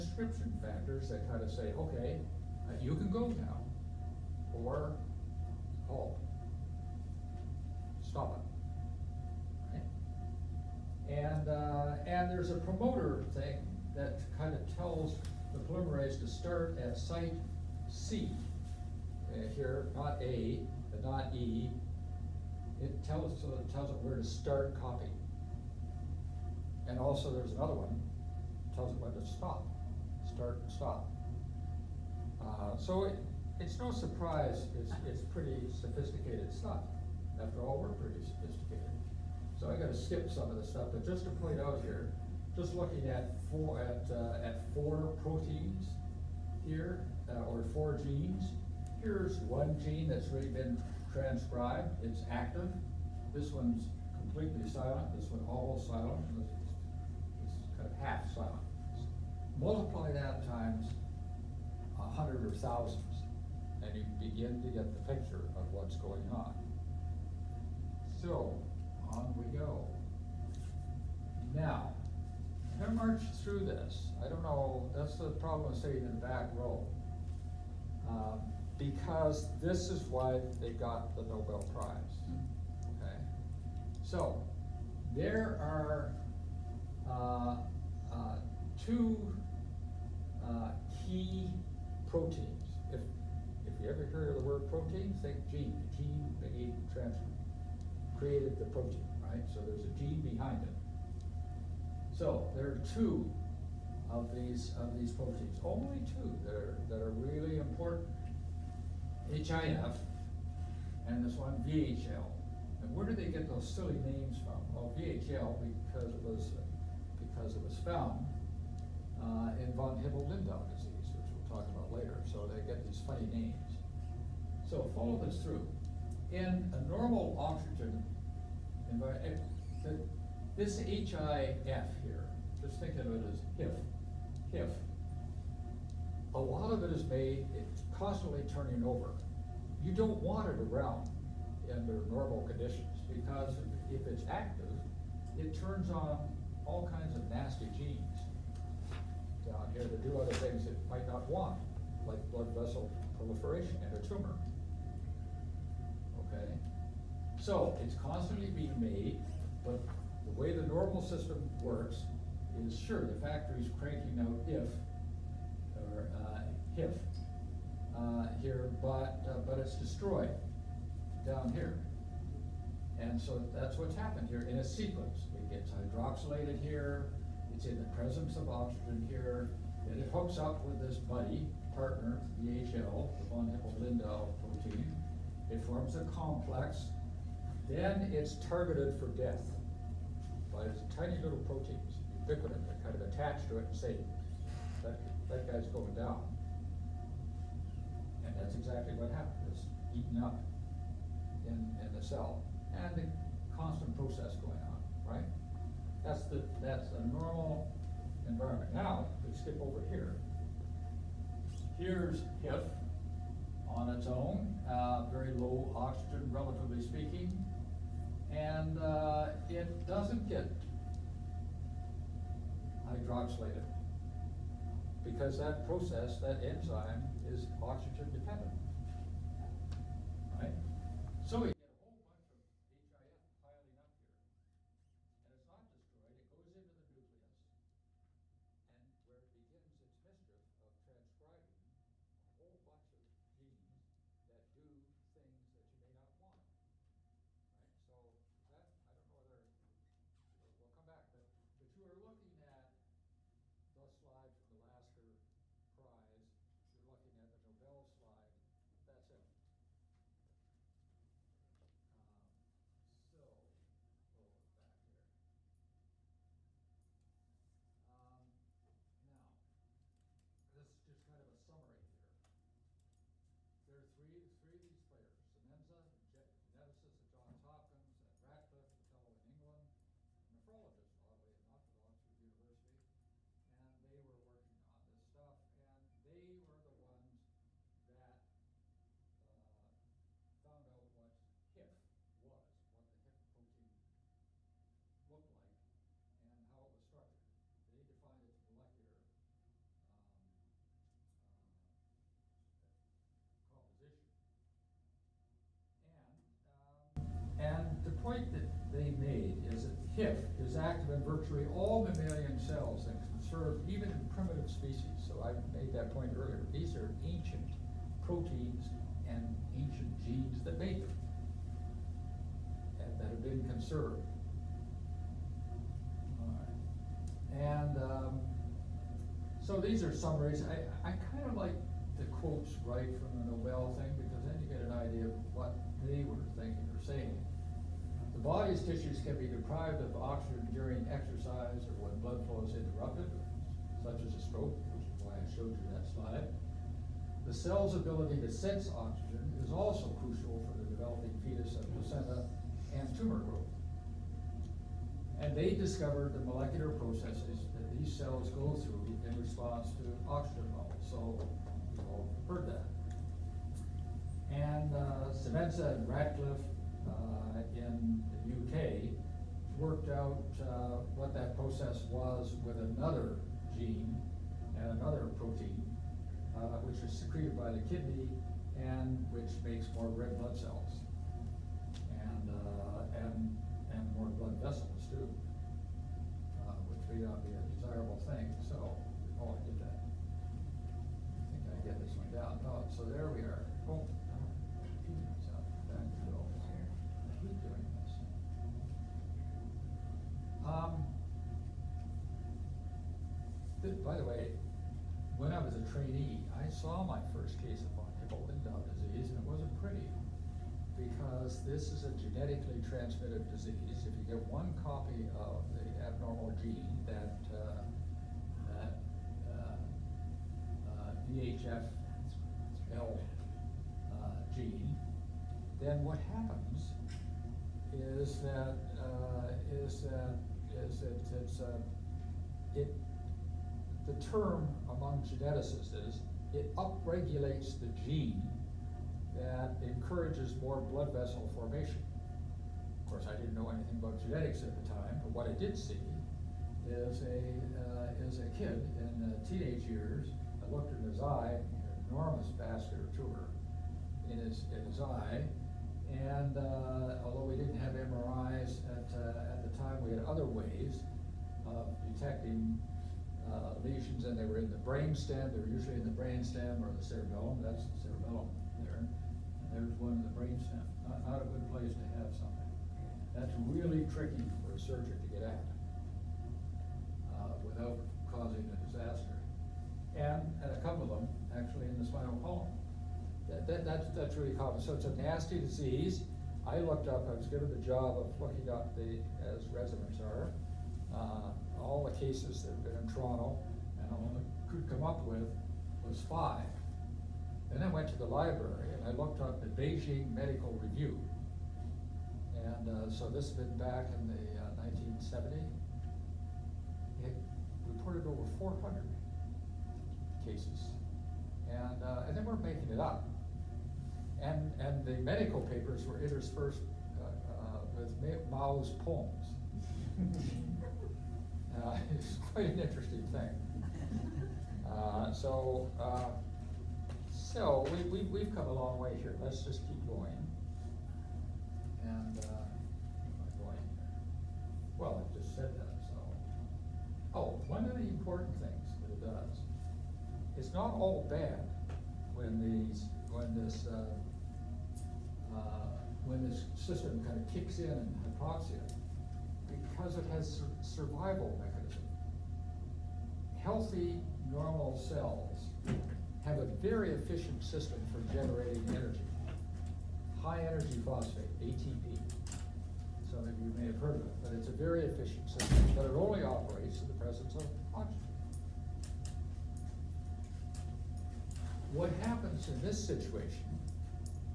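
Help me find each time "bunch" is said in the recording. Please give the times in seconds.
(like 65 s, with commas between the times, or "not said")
232 s, 242 s.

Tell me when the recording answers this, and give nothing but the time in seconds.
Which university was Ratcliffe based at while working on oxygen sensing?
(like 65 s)
281 s.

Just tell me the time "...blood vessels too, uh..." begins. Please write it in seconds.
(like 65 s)
384 s.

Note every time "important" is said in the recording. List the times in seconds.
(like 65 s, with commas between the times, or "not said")
107 s, 537 s.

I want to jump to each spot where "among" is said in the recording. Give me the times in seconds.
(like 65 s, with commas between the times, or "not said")
434 s.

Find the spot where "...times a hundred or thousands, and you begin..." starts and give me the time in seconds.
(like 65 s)
60 s.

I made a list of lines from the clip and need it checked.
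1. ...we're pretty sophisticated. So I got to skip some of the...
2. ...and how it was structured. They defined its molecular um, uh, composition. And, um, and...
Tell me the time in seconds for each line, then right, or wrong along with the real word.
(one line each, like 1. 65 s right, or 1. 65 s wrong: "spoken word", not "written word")
1. 37 s right
2. 296 s right.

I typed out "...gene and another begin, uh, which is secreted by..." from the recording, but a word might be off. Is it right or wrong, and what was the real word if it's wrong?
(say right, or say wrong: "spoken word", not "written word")
wrong: "protein", not "begin".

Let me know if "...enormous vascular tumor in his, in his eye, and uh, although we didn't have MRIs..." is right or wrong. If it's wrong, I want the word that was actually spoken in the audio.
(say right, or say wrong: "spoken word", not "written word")
right.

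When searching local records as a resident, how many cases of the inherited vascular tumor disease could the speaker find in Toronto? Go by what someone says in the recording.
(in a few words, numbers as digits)
5.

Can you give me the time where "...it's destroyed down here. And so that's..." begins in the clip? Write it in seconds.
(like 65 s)
169 s.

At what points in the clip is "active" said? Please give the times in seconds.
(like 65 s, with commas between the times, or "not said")
52 s, 144 s, 310 s.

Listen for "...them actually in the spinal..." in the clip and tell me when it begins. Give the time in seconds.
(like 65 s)
480 s.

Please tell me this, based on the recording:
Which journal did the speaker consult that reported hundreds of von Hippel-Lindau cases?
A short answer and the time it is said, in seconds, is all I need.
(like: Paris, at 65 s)
Beijing Medical Review, at 499 s.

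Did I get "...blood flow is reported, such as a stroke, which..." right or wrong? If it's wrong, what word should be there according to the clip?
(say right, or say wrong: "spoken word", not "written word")
wrong: "interrupted", not "reported".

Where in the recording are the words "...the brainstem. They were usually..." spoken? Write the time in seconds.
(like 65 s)
464 s.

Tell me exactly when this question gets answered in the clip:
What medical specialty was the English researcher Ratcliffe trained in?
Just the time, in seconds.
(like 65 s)
280 s.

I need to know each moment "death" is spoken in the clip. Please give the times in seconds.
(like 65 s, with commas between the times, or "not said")
189 s.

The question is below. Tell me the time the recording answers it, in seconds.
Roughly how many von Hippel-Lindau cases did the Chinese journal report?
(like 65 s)
508 s.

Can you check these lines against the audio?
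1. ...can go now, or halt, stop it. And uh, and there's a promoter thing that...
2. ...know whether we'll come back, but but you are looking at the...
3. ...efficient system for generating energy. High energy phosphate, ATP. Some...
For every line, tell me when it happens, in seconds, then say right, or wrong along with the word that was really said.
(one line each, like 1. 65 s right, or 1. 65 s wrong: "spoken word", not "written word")
1. 2 s right
2. 249 s right
3. 556 s right.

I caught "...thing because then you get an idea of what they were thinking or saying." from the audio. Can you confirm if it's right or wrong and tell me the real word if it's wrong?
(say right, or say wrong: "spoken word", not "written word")
right.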